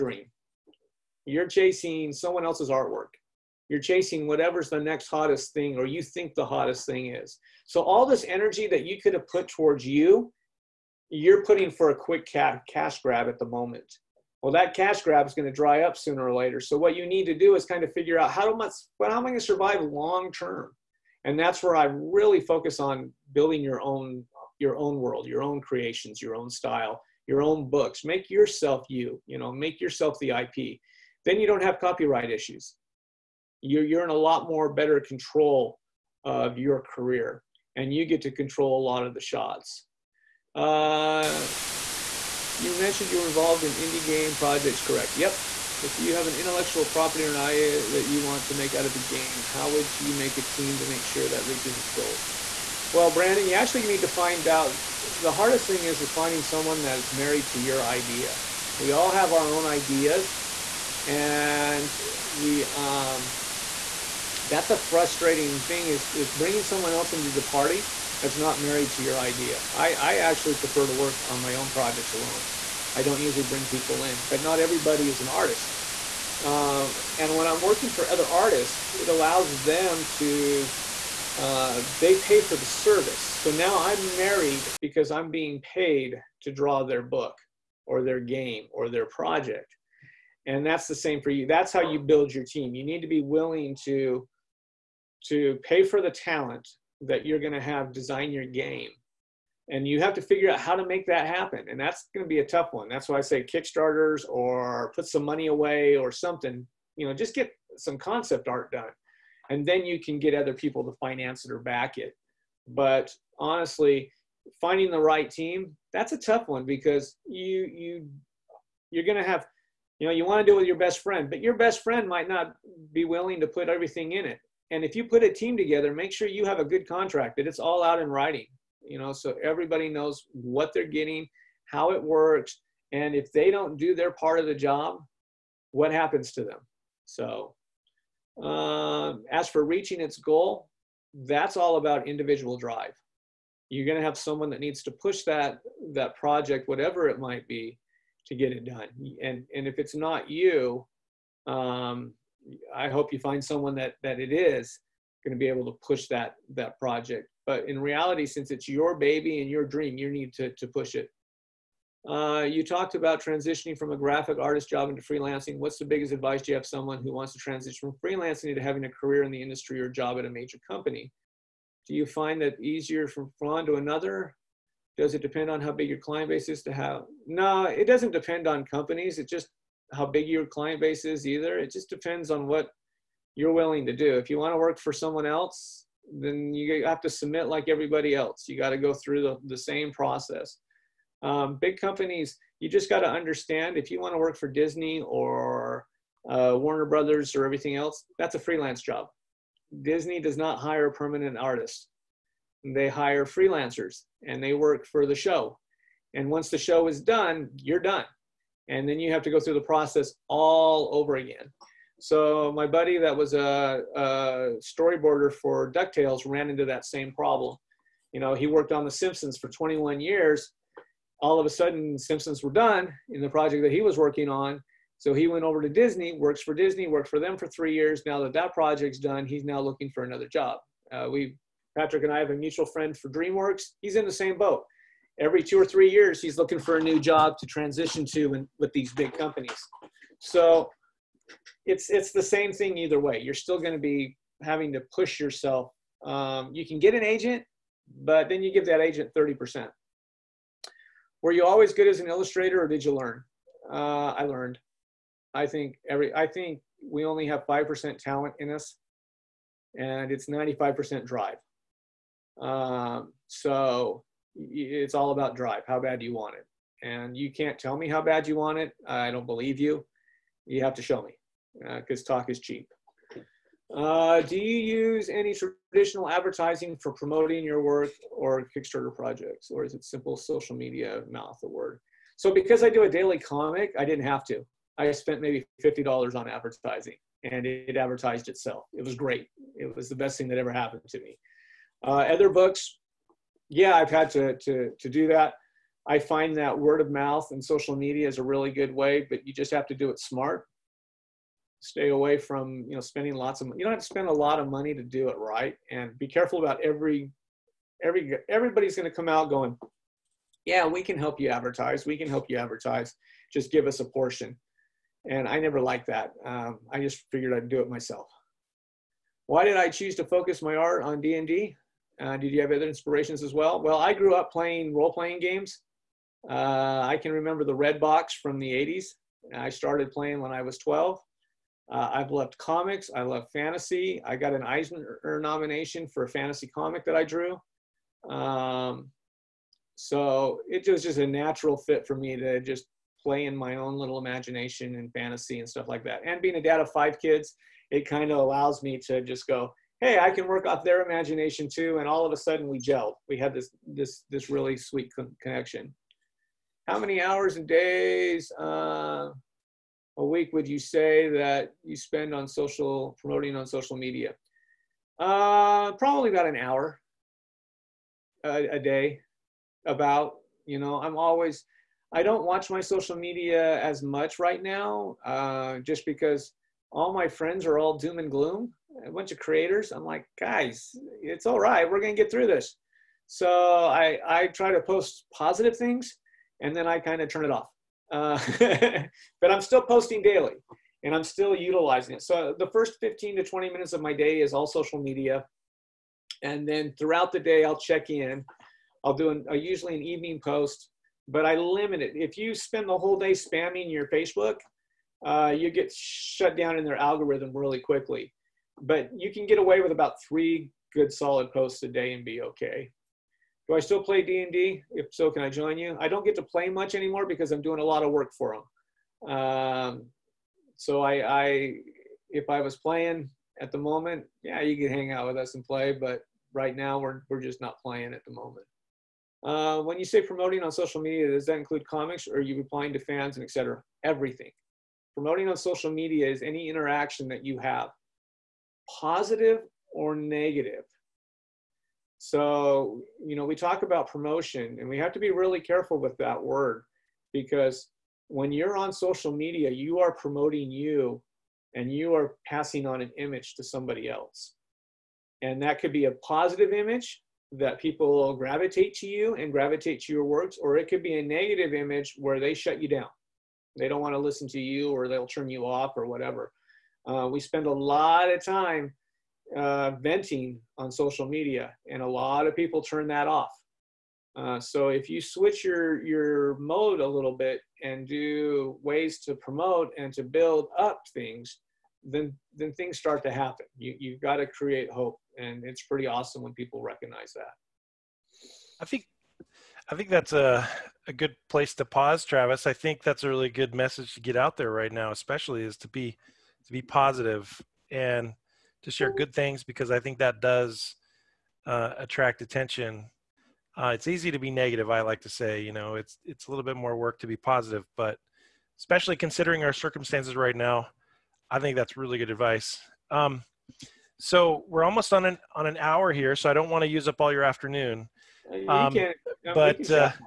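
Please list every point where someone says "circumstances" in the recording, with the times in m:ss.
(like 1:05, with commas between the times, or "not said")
8:29.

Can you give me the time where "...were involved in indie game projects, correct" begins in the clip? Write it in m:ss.
0:43.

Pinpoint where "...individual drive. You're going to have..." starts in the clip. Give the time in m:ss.
2:22.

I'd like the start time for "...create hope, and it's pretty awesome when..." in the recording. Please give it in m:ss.
8:04.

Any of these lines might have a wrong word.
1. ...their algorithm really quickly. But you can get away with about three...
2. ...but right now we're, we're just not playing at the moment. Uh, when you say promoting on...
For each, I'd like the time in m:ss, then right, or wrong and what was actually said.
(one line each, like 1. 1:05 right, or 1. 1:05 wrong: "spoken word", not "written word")
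1. 6:46 right
2. 7:05 right.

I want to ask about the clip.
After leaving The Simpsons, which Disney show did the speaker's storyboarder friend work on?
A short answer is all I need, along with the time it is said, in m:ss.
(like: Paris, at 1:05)
DuckTales, at 3:35.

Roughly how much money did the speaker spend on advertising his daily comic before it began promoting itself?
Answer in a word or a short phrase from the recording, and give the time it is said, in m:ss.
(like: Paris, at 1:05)
$50, at 4:45.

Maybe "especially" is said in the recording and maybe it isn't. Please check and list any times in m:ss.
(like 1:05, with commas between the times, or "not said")
8:14, 8:28.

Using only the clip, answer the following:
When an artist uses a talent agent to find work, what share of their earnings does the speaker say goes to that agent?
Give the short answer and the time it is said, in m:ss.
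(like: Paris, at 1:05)
30%, at 4:09.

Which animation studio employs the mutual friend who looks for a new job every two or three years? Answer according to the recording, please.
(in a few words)
DreamWorks.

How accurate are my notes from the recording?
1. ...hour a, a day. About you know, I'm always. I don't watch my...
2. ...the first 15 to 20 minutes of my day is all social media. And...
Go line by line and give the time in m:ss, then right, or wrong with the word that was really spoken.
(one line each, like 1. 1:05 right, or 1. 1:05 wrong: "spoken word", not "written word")
1. 6:06 right
2. 6:32 right.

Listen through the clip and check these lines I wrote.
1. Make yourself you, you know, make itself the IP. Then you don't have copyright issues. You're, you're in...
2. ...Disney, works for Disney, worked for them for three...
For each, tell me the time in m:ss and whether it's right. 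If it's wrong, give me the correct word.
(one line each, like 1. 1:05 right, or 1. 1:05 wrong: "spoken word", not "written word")
1. 0:28 wrong: "yourself", not "itself"
2. 3:45 right.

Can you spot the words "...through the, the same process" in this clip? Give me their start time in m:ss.
3:08.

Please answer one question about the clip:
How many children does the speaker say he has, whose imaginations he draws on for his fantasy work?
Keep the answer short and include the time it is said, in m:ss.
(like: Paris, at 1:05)
5, at 5:46.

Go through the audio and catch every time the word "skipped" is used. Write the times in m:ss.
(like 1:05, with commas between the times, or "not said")
not said.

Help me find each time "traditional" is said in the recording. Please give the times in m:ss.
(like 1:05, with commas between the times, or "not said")
4:35.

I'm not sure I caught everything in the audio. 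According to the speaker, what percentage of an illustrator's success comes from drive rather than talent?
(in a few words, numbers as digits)
95%.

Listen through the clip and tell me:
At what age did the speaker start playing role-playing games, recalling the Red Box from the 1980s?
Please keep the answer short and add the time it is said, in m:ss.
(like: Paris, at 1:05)
12, at 5:30.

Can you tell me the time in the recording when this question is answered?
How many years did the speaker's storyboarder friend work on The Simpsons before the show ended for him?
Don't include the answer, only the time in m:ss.
3:39.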